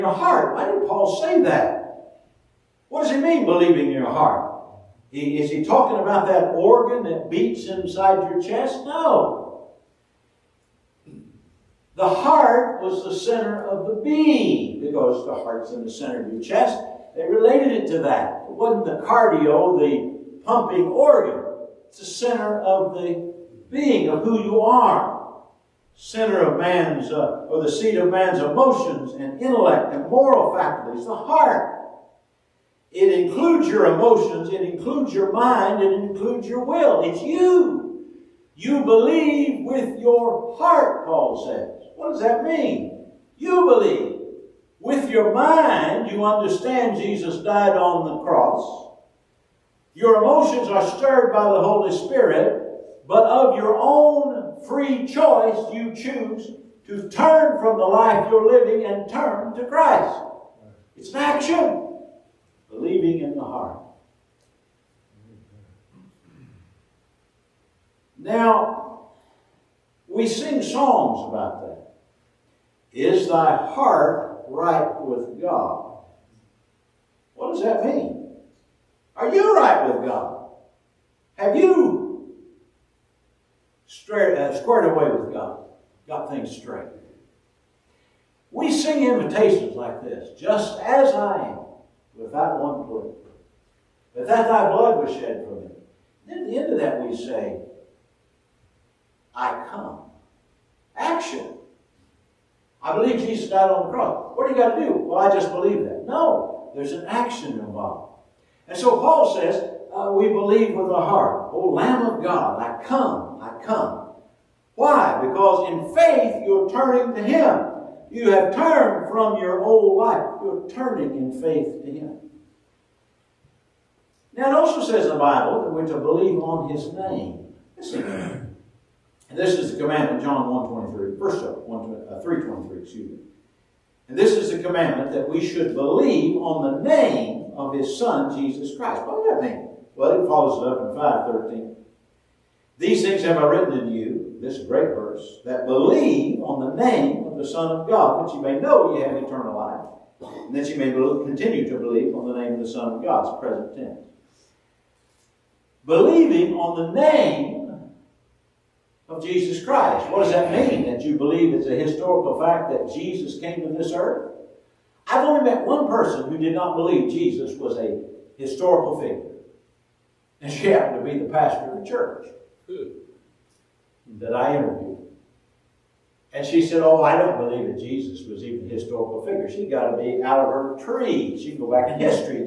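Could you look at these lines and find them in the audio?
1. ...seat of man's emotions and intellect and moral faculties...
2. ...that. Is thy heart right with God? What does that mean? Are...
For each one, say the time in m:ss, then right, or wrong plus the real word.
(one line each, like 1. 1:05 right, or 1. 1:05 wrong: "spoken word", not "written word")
1. 0:27 right
2. 1:11 right.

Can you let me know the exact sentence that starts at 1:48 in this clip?
And so Paul says, uh, we believe with our heart.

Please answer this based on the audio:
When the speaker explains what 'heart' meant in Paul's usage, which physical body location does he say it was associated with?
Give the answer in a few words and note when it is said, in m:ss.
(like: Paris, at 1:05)
center of your chest, at 0:15.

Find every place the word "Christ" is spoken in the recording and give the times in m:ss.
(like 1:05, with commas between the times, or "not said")
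0:59, 2:18, 2:39.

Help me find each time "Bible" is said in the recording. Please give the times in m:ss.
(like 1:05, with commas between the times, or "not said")
2:05.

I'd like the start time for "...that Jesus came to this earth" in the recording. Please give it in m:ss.
2:42.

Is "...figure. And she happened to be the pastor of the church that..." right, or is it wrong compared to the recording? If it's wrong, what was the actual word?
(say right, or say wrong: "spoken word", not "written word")
right.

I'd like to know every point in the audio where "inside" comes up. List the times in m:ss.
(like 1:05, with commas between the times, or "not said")
0:07.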